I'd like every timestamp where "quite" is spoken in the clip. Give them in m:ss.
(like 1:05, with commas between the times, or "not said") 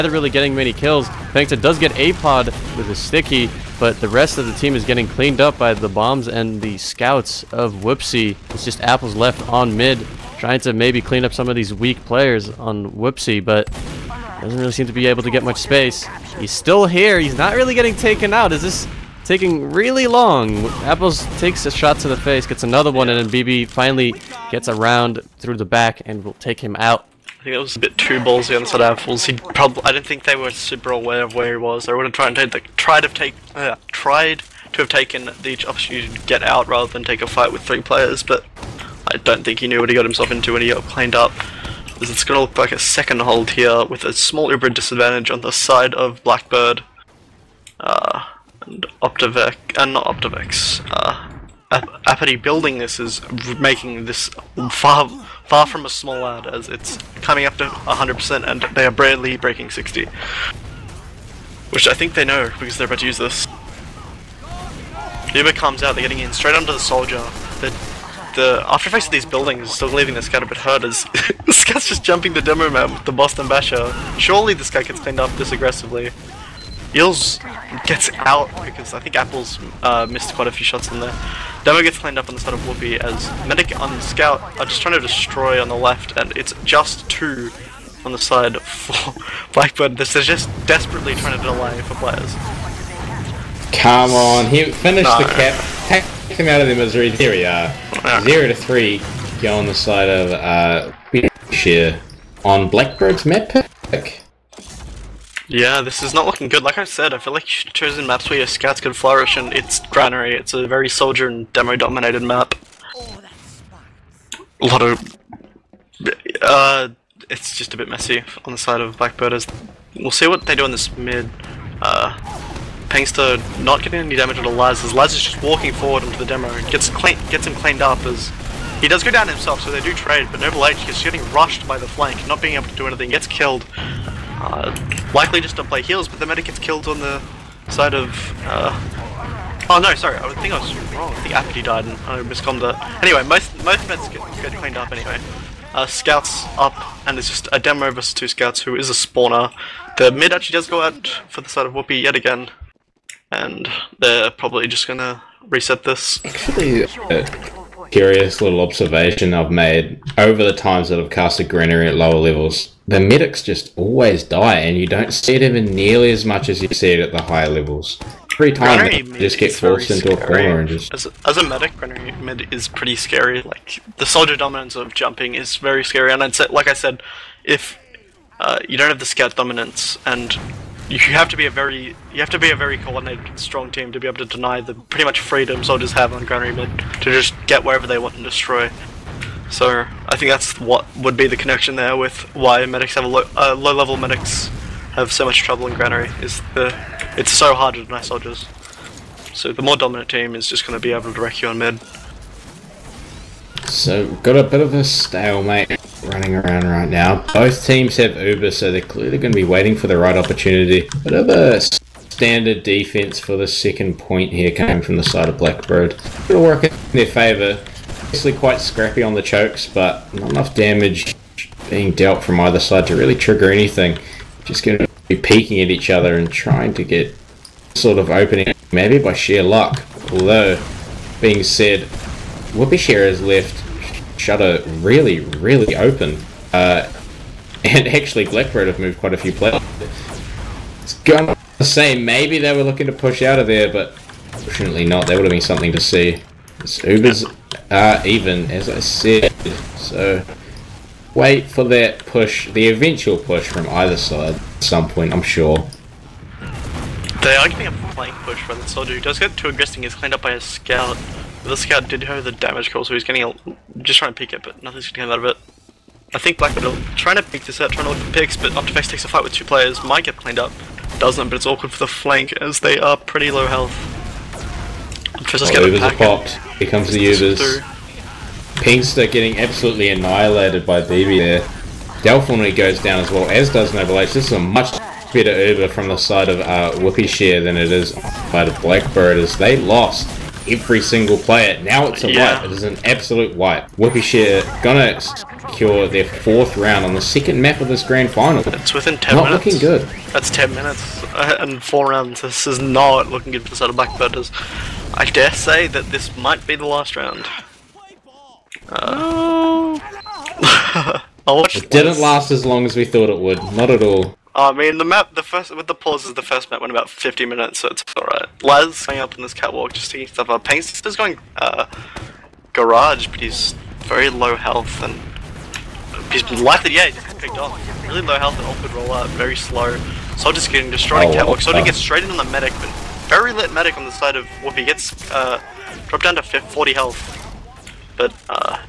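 1:20, 3:38, 3:58.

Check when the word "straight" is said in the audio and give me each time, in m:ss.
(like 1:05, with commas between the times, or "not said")
1:06, 5:31.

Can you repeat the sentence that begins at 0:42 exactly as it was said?
It's gonna look like a second hold here with a small Uber disadvantage on the side of Blackbird.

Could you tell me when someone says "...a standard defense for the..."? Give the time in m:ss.
3:31.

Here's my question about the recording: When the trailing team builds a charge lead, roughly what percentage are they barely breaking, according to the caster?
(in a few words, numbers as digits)
60.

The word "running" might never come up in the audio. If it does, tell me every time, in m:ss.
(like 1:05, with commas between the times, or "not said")
3:26.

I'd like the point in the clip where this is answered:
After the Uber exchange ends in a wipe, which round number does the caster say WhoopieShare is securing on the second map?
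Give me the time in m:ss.
4:56.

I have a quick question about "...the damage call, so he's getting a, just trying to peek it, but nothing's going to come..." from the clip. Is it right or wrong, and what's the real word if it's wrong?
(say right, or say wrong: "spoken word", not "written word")
right.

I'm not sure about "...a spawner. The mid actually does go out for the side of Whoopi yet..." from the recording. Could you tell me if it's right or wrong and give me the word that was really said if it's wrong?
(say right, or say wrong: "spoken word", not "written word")
right.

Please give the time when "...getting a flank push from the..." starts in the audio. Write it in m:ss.
4:17.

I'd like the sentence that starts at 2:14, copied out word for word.
Uh, likely just to play heals, but the medic gets killed on the side of...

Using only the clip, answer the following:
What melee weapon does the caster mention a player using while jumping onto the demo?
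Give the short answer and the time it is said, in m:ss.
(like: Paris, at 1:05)
Boston Basher, at 1:13.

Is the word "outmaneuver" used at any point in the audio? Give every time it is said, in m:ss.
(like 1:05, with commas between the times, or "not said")
not said.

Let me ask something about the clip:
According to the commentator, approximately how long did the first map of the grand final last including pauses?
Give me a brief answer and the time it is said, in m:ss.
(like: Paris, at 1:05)
50 minutes, at 5:16.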